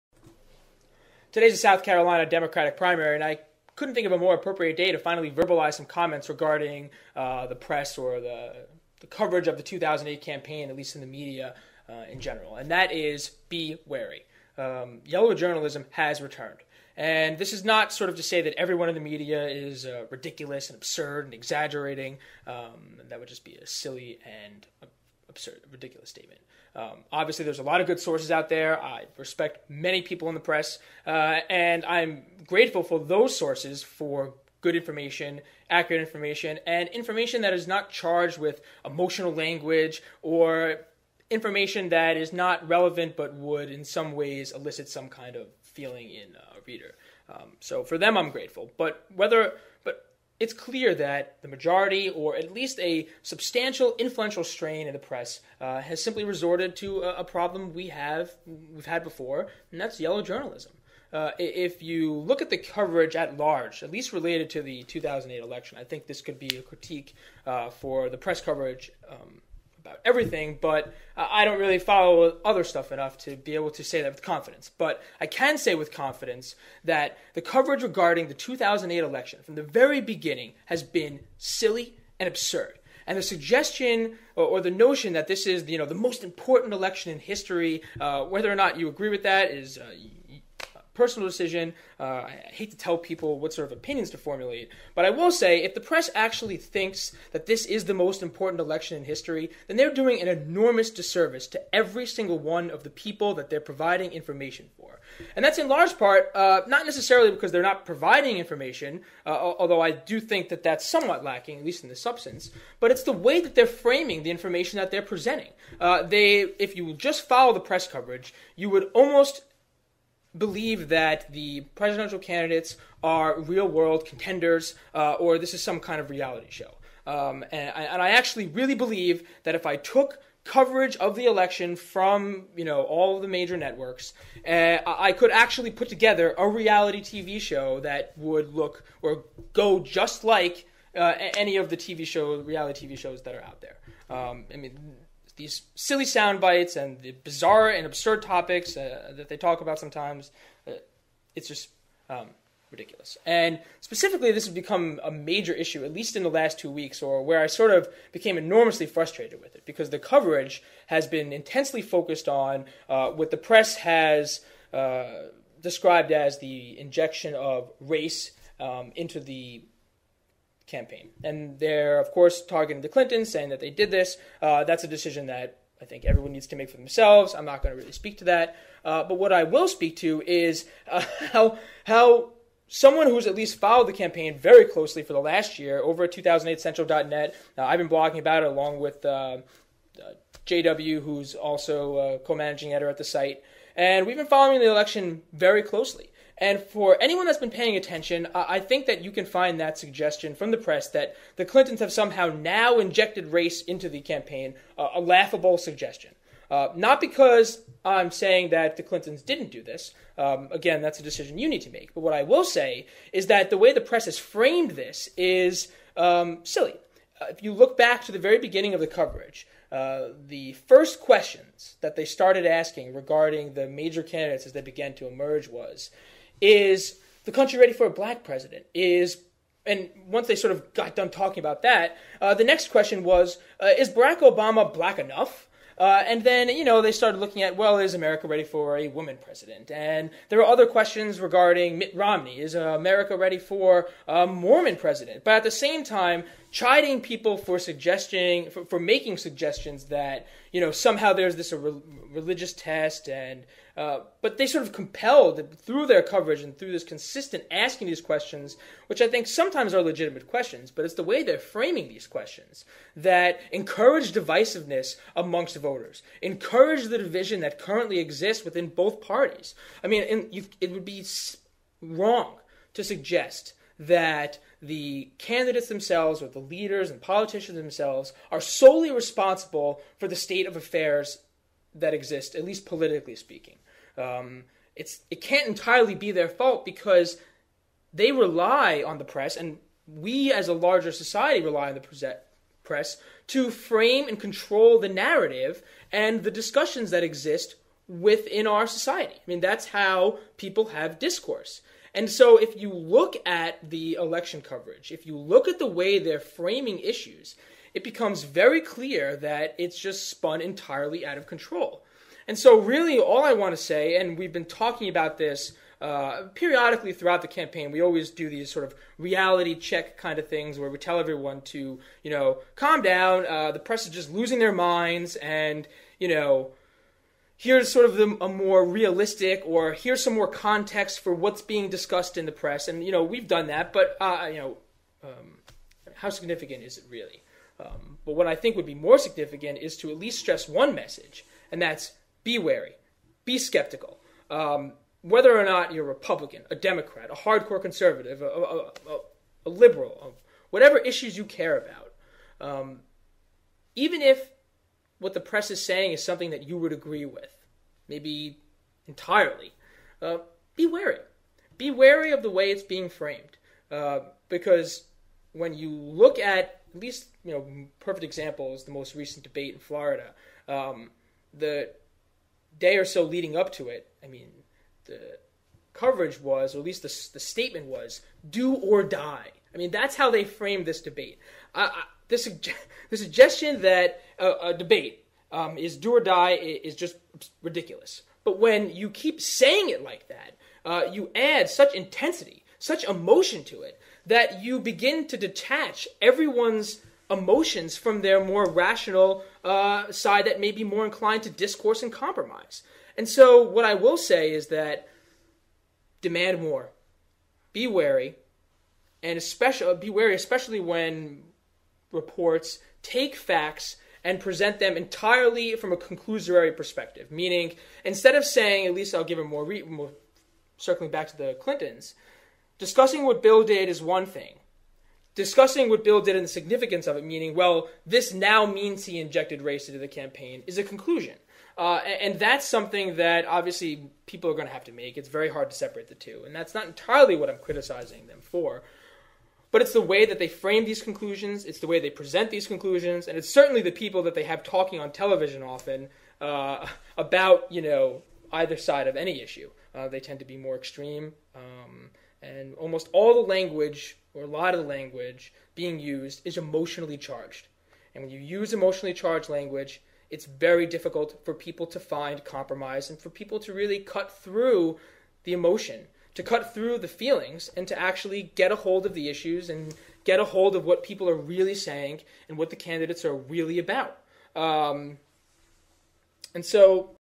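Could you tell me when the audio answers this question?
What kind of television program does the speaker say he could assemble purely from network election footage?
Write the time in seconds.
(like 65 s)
136 s.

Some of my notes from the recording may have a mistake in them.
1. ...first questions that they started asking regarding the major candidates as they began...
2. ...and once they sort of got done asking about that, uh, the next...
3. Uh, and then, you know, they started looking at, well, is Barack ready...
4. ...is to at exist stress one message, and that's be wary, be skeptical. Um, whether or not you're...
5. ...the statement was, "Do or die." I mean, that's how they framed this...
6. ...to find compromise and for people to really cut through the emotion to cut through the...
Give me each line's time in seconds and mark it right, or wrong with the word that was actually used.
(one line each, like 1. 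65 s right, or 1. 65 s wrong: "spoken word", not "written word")
1. 220 s right
2. 229 s wrong: "talking", not "asking"
3. 235 s wrong: "America", not "Barack"
4. 339 s wrong: "least", not "exist"
5. 377 s right
6. 461 s right.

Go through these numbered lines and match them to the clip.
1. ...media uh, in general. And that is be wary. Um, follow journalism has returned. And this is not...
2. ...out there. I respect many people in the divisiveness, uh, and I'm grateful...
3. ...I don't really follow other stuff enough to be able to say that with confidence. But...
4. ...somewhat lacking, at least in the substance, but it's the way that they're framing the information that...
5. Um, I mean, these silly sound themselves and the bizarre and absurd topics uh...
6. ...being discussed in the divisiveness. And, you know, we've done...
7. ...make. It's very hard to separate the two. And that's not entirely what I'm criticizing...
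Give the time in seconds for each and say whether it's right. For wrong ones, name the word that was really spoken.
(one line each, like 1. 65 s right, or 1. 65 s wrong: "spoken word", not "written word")
1. 11 s wrong: "yellow", not "follow"
2. 28 s wrong: "press", not "divisiveness"
3. 71 s right
4. 110 s right
5. 144 s wrong: "bites", not "themselves"
6. 331 s wrong: "press", not "divisiveness"
7. 434 s right.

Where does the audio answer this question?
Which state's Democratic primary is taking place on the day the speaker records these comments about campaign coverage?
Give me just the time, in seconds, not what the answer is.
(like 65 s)
1 s.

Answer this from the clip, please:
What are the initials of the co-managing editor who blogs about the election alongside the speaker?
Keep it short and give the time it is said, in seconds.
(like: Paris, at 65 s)
JW, at 190 s.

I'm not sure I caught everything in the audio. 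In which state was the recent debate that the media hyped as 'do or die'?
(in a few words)
Florida.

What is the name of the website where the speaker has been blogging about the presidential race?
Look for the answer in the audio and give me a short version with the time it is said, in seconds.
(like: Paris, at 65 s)
2008central.net, at 186 s.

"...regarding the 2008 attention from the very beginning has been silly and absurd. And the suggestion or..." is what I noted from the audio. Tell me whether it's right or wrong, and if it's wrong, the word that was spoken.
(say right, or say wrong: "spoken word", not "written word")
wrong: "election", not "attention".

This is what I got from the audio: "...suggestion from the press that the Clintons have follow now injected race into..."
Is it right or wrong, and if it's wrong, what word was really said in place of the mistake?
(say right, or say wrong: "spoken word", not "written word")
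wrong: "somehow", not "follow".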